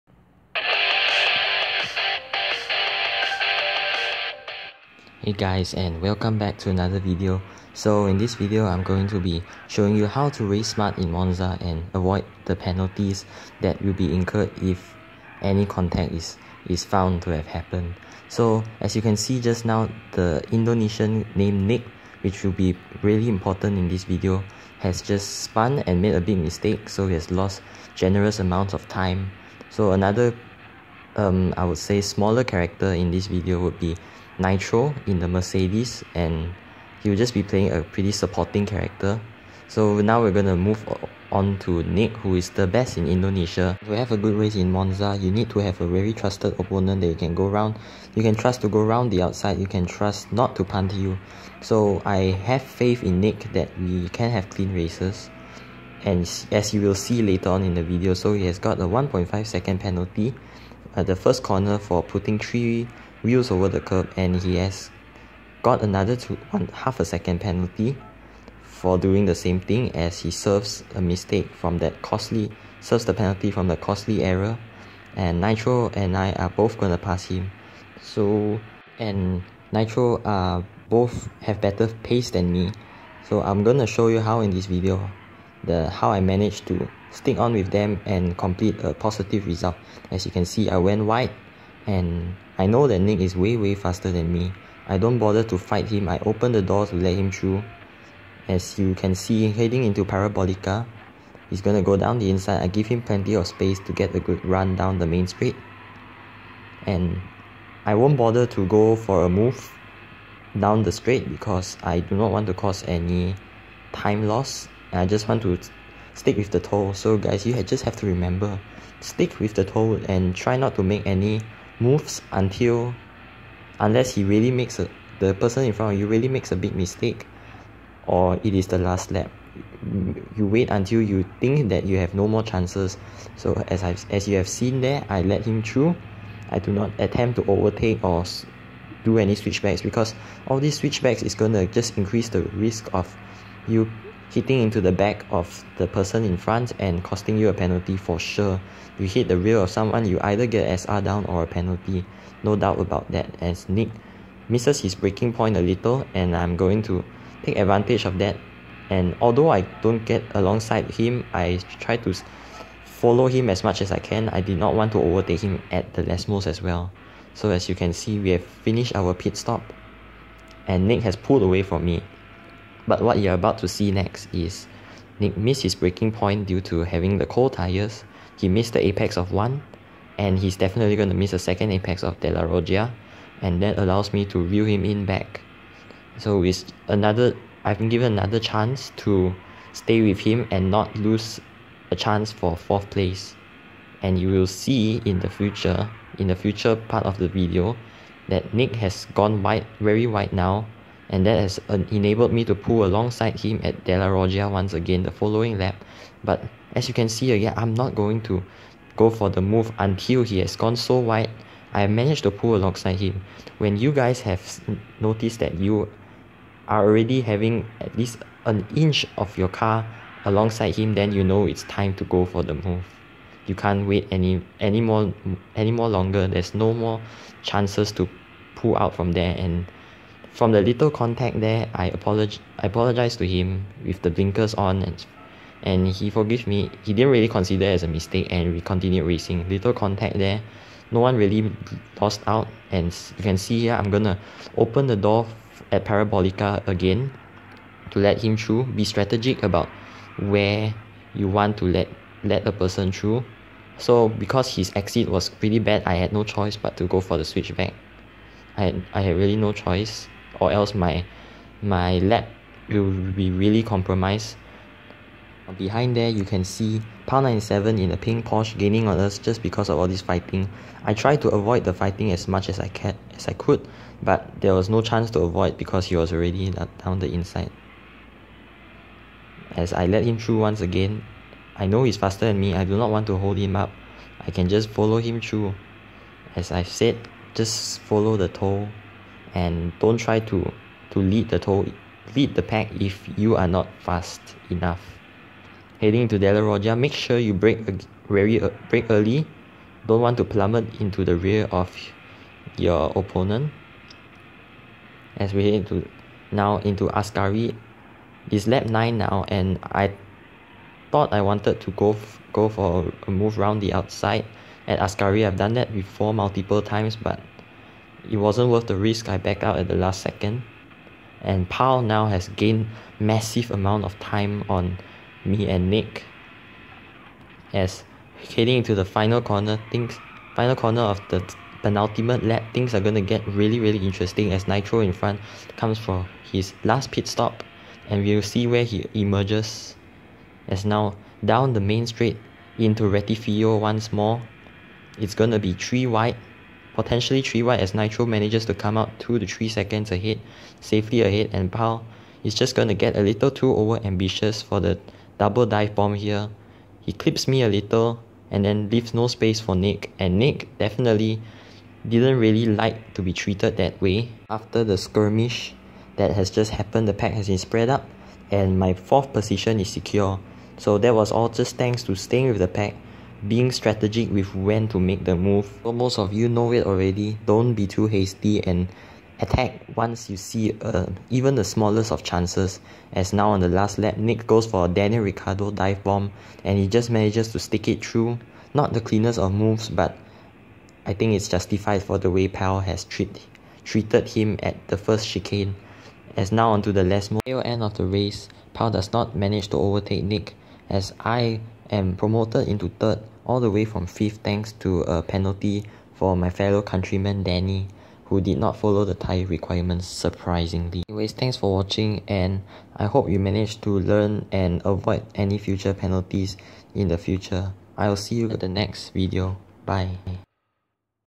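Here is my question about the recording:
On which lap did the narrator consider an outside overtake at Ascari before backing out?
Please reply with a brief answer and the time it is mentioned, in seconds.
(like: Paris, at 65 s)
lap 9, at 308 s.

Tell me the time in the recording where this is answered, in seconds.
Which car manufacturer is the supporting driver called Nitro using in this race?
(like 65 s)
35 s.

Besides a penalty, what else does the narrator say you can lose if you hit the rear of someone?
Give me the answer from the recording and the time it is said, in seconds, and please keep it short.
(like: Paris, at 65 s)
SR, at 150 s.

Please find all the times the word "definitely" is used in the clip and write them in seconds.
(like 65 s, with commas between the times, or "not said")
180 s, 360 s.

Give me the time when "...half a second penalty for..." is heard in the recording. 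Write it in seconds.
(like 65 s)
66 s.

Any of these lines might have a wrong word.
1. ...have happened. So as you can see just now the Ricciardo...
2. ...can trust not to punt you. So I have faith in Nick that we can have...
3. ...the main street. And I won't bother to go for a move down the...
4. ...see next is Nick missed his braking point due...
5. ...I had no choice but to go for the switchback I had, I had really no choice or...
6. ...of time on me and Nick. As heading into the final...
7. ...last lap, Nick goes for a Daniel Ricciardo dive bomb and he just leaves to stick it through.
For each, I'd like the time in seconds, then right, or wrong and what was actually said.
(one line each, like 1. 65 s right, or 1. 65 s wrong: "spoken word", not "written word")
1. 17 s wrong: "Indonesian", not "Ricciardo"
2. 49 s right
3. 104 s right
4. 173 s right
5. 255 s right
6. 323 s right
7. 383 s wrong: "manages", not "leaves".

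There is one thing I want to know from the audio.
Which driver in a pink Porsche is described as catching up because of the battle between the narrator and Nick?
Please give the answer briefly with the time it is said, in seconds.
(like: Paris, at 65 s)
Pal 97, at 267 s.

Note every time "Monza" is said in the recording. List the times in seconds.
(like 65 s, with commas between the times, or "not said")
11 s, 44 s.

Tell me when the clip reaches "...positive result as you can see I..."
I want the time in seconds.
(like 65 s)
88 s.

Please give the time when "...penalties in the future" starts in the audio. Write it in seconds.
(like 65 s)
415 s.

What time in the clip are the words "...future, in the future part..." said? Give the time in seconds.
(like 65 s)
195 s.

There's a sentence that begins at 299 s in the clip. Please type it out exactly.
Don't want to plummet into the rear of your opponent.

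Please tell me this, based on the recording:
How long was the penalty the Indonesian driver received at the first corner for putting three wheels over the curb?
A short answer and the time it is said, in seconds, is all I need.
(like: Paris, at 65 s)
1.5 seconds, at 58 s.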